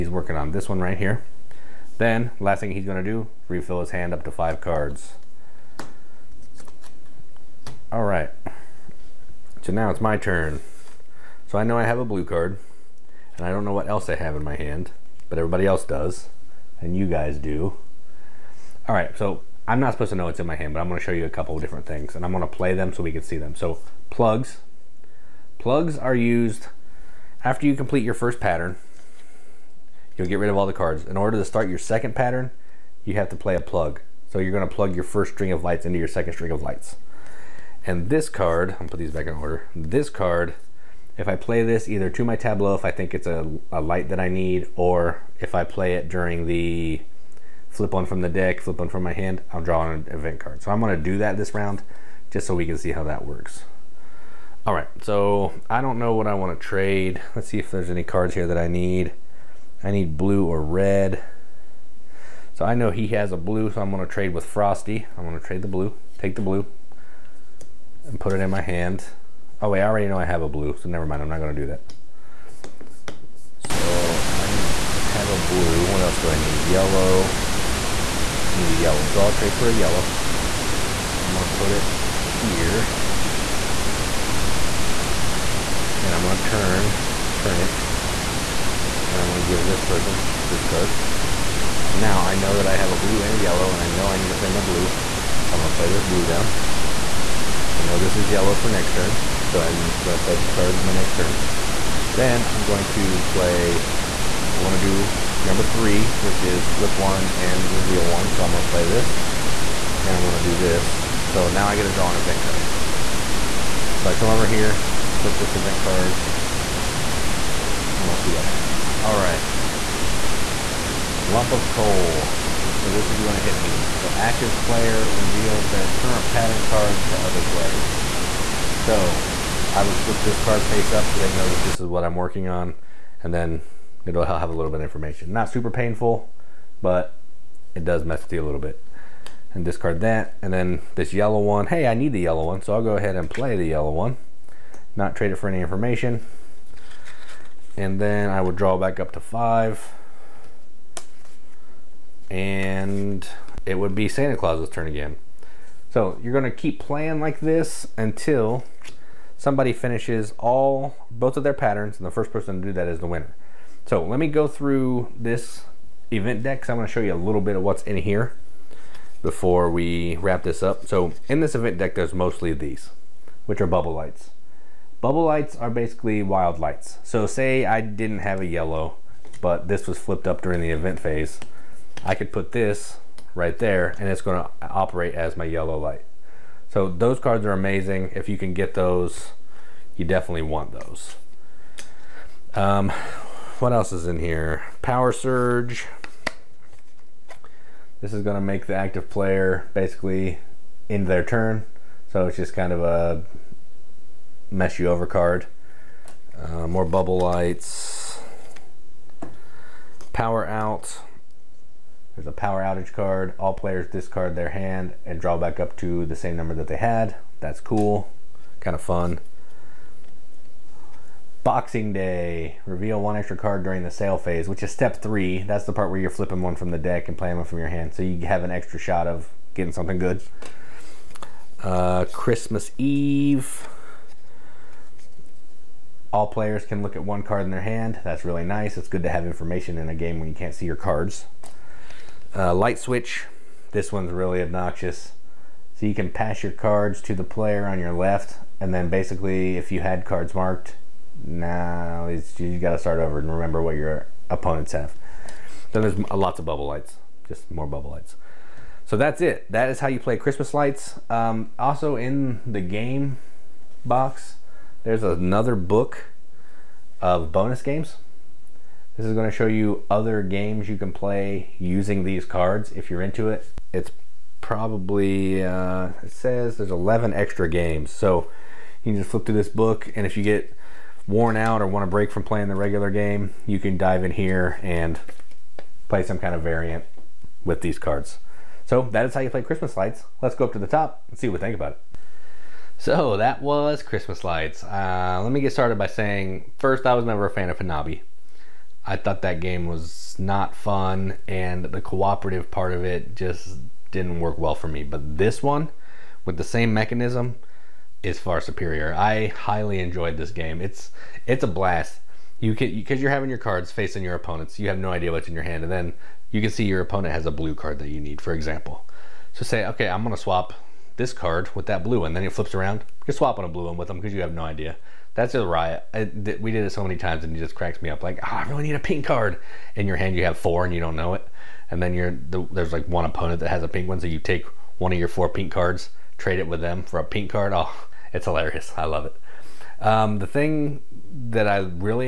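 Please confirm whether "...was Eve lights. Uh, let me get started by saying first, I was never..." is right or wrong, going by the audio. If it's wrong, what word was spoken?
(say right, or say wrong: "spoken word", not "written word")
wrong: "Christmas", not "Eve".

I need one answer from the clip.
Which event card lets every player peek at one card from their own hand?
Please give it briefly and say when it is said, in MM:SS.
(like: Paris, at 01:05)
Christmas Eve, at 03:52.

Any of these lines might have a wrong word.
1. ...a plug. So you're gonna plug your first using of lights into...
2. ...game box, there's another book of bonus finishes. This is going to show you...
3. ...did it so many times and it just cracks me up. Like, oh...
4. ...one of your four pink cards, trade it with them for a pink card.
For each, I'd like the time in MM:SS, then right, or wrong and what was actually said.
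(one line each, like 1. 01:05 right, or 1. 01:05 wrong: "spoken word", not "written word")
1. 00:33 wrong: "string", not "using"
2. 04:22 wrong: "games", not "finishes"
3. 05:26 right
4. 05:34 right.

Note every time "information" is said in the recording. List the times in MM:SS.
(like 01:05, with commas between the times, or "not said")
02:14, 02:25, 03:59.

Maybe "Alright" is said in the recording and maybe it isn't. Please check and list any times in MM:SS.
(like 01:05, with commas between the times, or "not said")
00:07, 00:18.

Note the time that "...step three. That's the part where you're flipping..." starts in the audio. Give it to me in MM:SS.
03:44.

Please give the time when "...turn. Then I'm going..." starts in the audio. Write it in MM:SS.
01:41.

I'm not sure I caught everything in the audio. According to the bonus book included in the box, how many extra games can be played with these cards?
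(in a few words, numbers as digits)
11.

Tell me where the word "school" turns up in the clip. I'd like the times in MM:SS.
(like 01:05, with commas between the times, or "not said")
not said.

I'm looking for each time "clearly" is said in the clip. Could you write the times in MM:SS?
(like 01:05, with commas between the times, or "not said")
not said.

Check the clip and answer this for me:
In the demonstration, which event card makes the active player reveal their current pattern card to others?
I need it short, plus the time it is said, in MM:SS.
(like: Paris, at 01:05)
Lump of coal, at 02:01.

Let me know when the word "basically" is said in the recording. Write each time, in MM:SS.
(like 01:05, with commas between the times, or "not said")
02:55, 03:19, 04:08.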